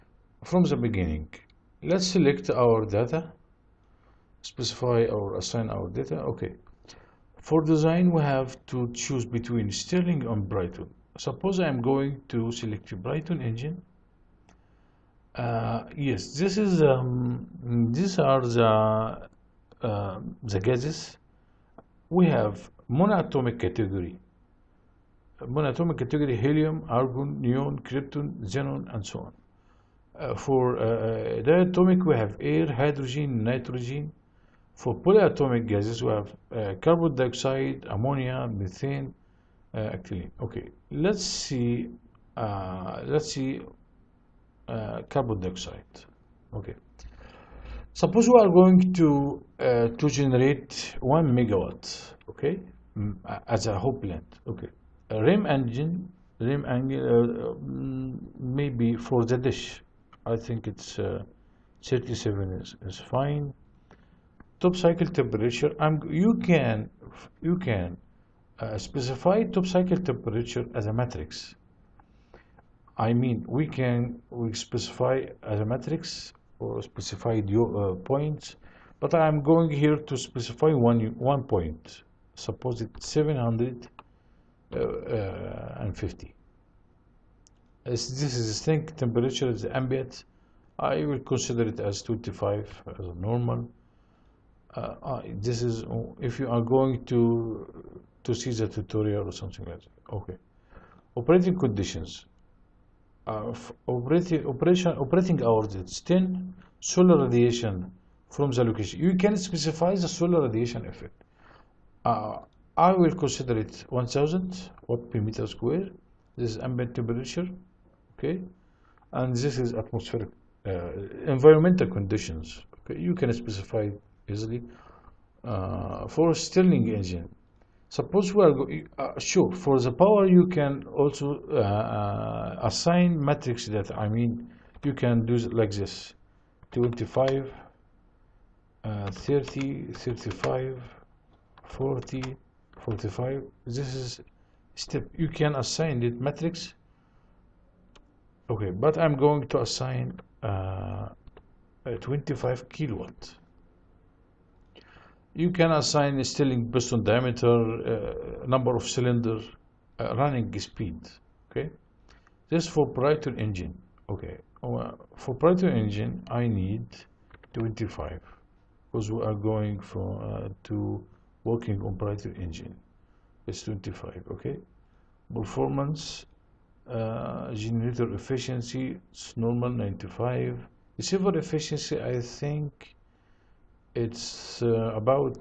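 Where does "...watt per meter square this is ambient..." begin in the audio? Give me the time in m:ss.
1:54.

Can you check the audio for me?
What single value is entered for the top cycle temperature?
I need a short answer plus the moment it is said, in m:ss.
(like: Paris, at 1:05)
750, at 1:23.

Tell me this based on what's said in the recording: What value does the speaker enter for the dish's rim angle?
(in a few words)
37.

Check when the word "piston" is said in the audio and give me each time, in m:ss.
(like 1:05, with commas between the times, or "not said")
2:36.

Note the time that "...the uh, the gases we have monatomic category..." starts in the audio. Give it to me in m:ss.
0:18.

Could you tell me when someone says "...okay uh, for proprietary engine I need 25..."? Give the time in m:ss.
2:44.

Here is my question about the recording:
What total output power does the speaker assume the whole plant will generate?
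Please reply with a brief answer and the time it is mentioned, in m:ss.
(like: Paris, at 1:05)
1 megawatt, at 0:50.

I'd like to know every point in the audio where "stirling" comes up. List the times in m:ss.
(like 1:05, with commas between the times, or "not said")
0:09, 2:06, 2:36.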